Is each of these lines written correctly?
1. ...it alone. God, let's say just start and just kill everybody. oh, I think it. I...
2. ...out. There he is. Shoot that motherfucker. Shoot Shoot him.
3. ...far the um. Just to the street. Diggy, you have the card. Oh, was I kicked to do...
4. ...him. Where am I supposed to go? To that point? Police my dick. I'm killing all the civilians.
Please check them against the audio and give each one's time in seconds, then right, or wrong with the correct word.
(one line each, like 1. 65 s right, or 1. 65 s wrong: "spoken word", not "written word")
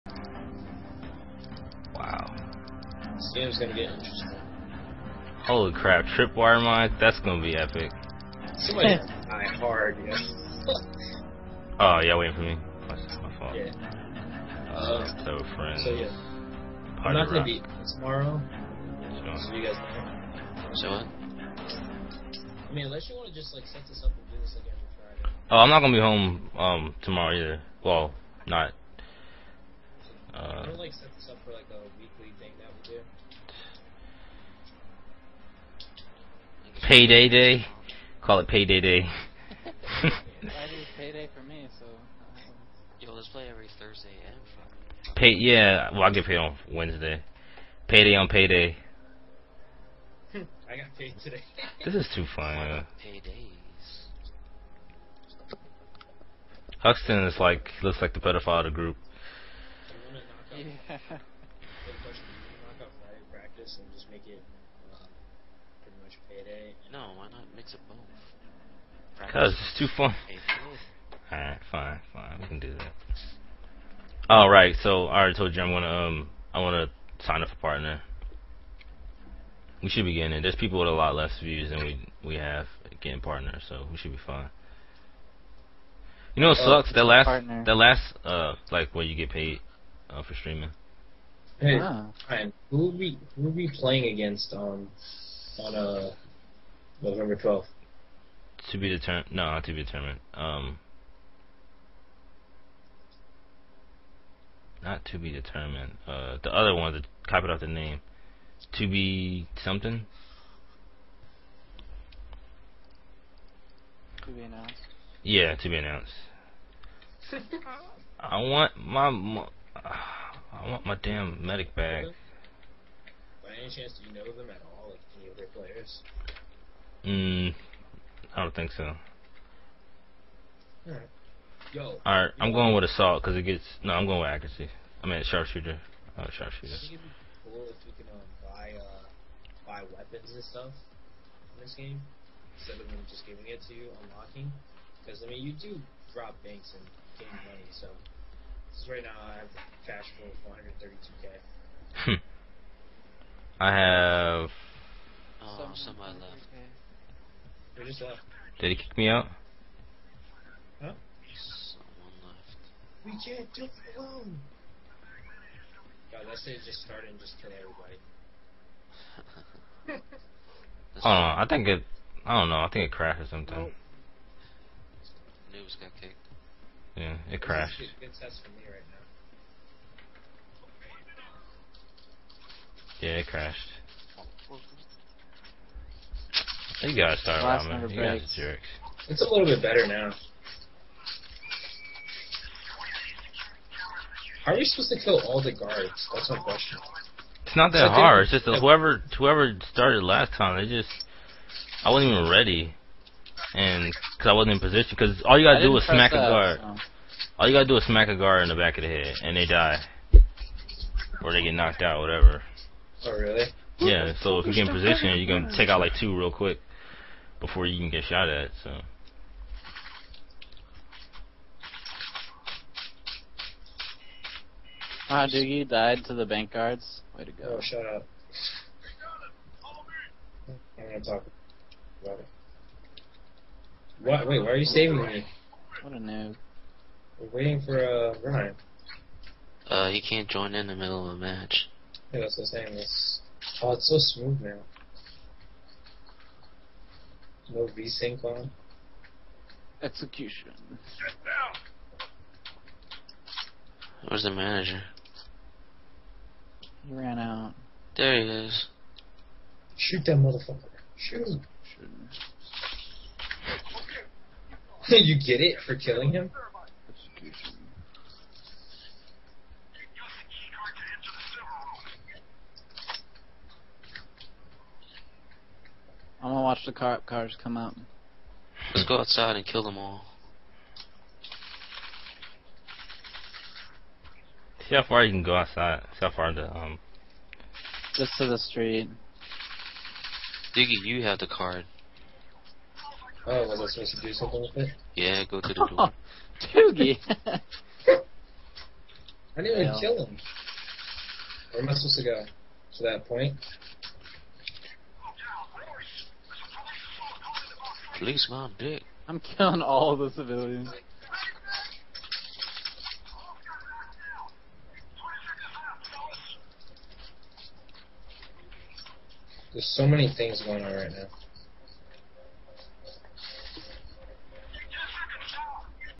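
1. 163 s right
2. 257 s right
3. 286 s wrong: "supposed", not "kicked"
4. 300 s right.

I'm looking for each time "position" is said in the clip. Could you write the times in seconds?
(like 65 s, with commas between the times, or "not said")
204 s, 214 s.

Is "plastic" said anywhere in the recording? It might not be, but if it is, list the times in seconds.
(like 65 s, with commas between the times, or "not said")
not said.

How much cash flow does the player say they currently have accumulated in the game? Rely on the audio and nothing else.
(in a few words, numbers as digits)
132k.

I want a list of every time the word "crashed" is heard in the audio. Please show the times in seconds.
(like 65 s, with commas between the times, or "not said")
172 s, 177 s, 183 s.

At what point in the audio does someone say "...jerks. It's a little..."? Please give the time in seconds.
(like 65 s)
188 s.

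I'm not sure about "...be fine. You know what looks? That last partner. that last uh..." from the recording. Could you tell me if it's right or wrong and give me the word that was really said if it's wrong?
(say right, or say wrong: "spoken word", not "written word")
wrong: "sucks", not "looks".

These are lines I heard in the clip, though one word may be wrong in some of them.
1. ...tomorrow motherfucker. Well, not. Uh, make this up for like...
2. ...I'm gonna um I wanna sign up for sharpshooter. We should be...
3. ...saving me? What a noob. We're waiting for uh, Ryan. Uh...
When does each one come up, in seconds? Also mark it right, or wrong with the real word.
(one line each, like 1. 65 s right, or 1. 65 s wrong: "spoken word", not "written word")
1. 27 s wrong: "either", not "motherfucker"
2. 75 s wrong: "partner", not "sharpshooter"
3. 234 s right.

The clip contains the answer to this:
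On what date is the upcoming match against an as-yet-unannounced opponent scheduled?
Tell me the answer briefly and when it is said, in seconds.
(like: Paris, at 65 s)
November 12, at 97 s.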